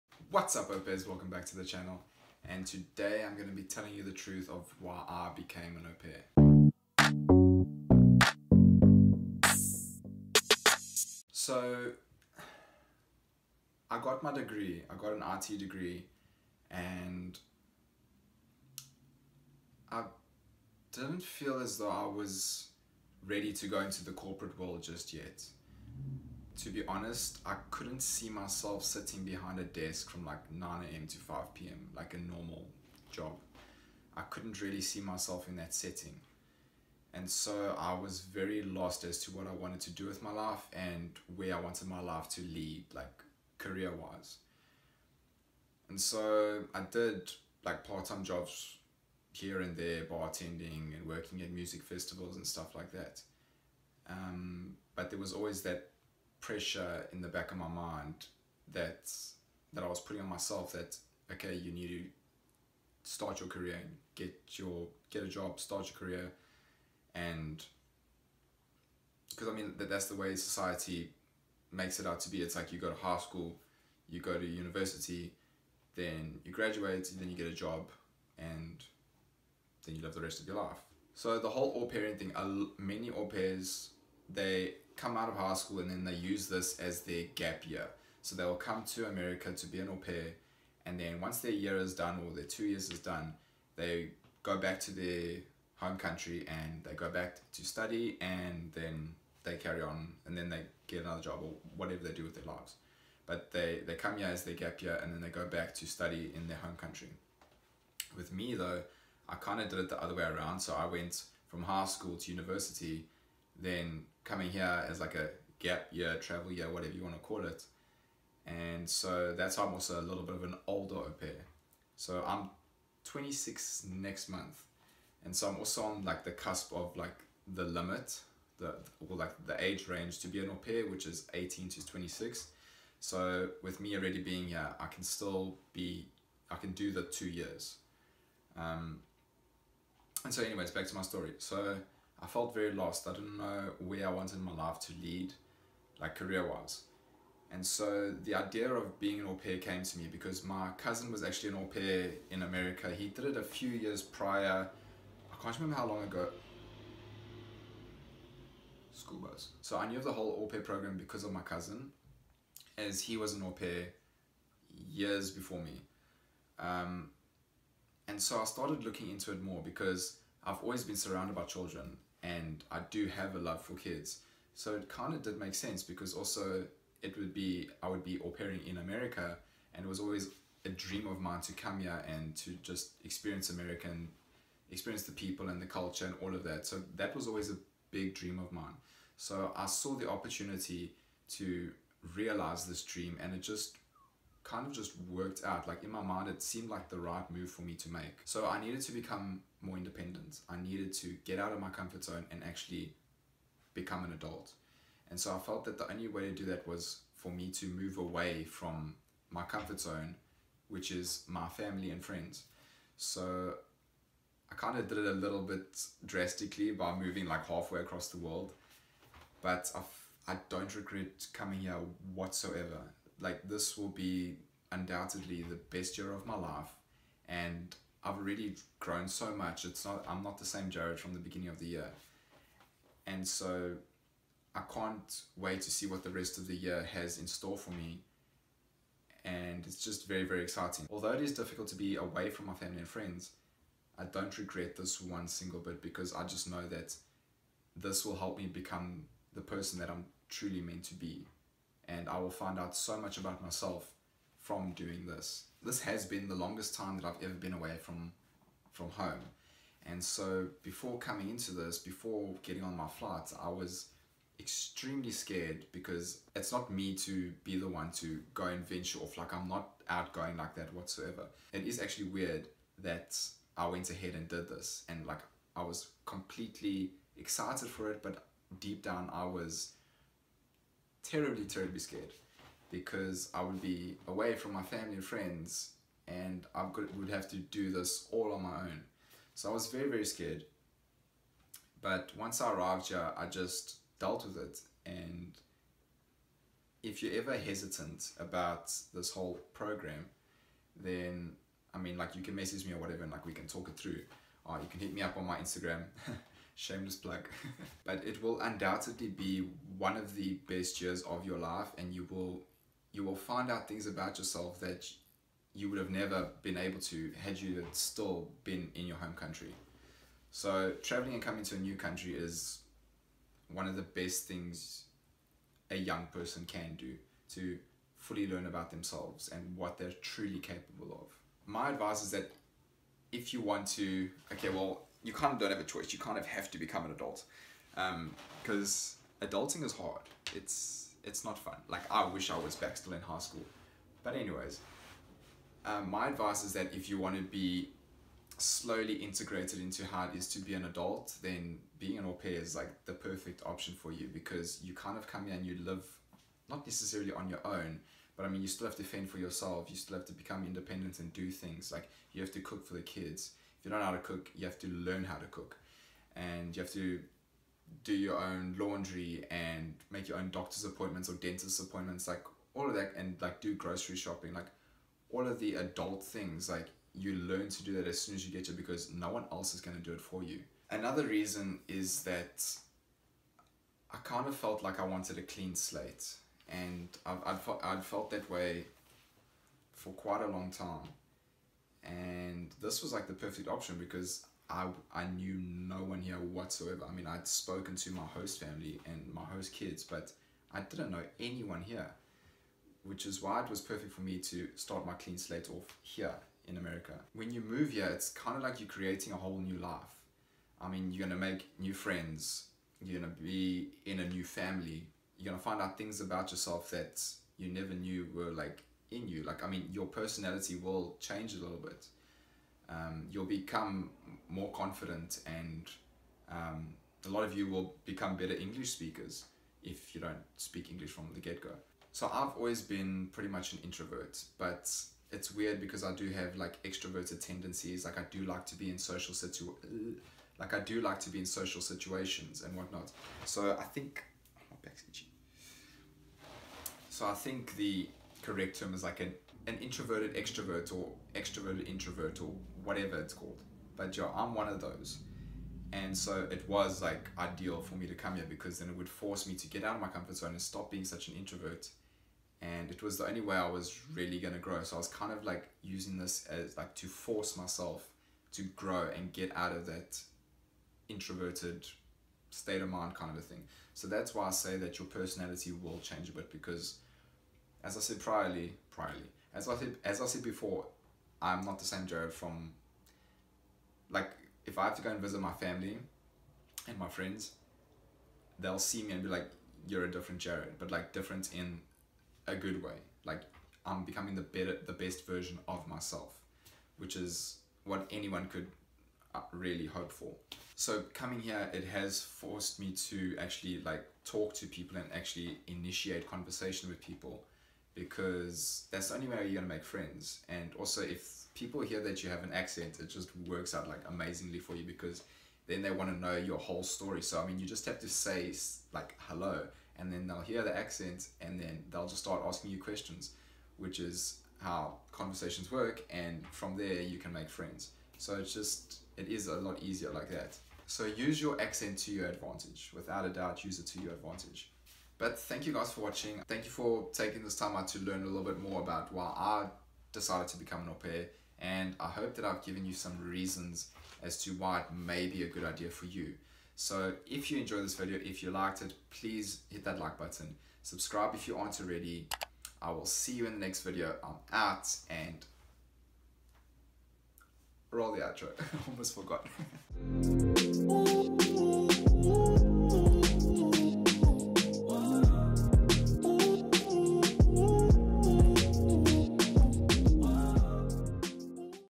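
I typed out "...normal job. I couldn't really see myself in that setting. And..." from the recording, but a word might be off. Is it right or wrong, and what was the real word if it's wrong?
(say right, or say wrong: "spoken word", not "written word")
right.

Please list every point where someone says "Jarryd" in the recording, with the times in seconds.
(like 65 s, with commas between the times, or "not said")
230 s, 481 s, 490 s.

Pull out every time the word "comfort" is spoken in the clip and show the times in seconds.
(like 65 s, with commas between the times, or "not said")
201 s, 209 s, 459 s.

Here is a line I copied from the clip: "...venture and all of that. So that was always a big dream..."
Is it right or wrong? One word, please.
wrong.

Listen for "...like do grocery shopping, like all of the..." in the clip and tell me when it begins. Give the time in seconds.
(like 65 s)
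373 s.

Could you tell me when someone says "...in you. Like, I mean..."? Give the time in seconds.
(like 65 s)
418 s.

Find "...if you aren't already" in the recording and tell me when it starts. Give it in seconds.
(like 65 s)
551 s.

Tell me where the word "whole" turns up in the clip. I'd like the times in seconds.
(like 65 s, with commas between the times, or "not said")
81 s, 160 s, 299 s, 409 s, 516 s.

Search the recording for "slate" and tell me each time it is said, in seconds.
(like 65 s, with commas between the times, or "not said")
385 s, 405 s.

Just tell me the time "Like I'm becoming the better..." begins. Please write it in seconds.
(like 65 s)
493 s.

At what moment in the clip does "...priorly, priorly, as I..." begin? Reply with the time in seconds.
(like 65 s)
477 s.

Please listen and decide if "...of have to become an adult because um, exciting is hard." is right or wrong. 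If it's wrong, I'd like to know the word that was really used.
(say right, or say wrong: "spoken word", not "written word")
wrong: "adulting", not "exciting".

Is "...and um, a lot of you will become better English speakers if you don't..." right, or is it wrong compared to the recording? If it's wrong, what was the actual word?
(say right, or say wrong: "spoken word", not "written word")
right.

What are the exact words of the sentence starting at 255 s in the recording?
This has been the longest time that I've ever been away from, from home.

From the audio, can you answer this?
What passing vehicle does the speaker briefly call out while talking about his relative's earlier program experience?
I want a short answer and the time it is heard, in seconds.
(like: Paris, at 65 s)
School bus, at 158 s.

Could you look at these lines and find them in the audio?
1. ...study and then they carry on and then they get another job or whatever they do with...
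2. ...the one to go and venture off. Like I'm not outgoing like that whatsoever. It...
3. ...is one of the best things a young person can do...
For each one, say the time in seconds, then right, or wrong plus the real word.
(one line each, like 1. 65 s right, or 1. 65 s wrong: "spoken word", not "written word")
1. 97 s right
2. 267 s right
3. 322 s right.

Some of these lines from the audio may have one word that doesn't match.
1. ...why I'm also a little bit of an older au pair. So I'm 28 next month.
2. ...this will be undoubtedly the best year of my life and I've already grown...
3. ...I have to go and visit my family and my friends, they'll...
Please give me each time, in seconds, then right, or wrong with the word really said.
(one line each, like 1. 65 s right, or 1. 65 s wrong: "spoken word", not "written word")
1. 119 s wrong: "26", not "28"
2. 223 s right
3. 484 s right.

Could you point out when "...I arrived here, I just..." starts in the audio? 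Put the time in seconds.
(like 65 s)
292 s.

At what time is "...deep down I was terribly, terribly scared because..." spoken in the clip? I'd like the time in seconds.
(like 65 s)
278 s.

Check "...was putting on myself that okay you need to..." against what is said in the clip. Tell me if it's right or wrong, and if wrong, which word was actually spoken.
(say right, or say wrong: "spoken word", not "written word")
right.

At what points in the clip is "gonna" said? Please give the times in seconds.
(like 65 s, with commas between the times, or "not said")
509 s.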